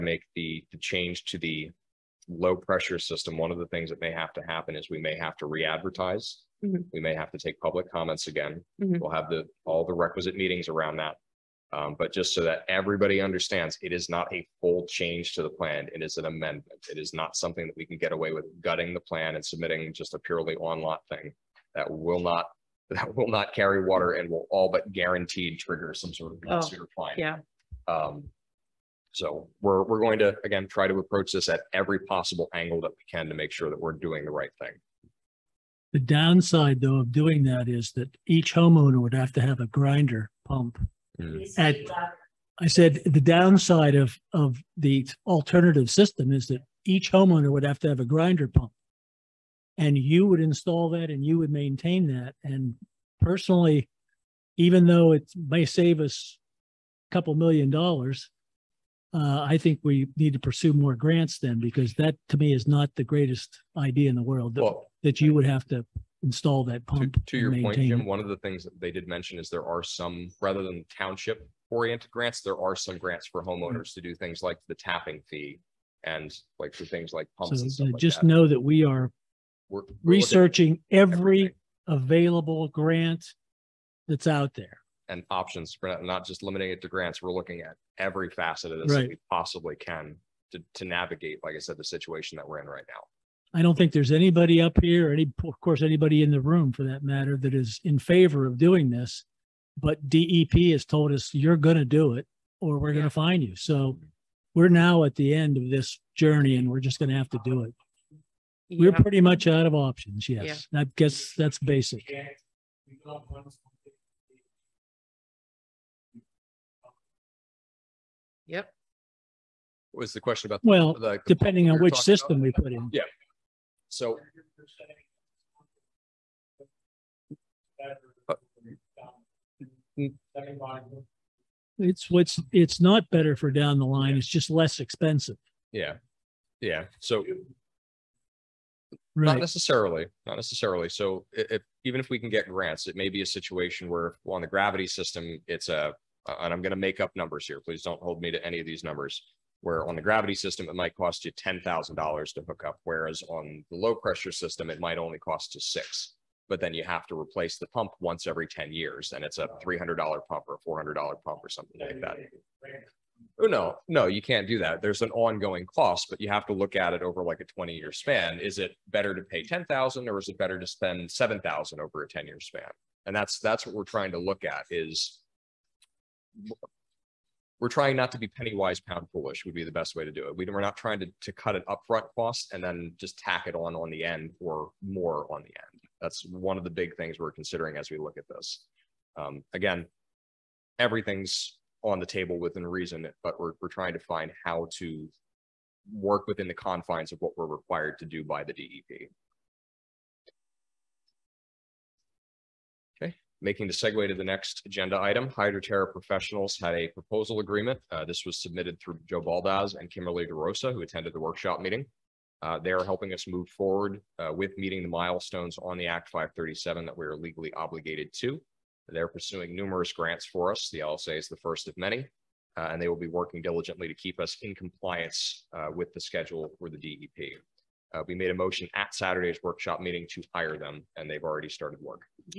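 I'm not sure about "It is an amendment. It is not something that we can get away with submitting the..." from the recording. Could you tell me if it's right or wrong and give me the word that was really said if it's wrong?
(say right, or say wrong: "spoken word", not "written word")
wrong: "gutting", not "submitting".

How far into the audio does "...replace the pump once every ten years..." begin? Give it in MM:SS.
02:37.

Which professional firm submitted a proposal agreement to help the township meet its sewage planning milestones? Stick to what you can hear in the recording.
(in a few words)
Hydroterra Professionals.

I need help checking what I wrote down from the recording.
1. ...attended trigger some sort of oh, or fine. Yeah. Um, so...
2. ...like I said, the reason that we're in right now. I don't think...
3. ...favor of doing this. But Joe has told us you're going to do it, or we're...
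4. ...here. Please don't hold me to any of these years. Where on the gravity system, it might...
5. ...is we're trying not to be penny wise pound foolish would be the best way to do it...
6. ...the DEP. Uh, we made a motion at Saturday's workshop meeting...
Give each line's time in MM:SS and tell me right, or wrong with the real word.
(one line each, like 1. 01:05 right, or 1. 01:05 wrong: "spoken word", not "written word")
1. 00:24 wrong: "guaranteed", not "attended"
2. 01:31 wrong: "situation", not "reason"
3. 01:37 wrong: "DEP", not "Joe"
4. 02:27 wrong: "numbers", not "years"
5. 02:54 right
6. 03:46 right.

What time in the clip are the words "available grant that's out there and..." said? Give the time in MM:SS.
01:21.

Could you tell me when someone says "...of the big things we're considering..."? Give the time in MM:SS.
03:06.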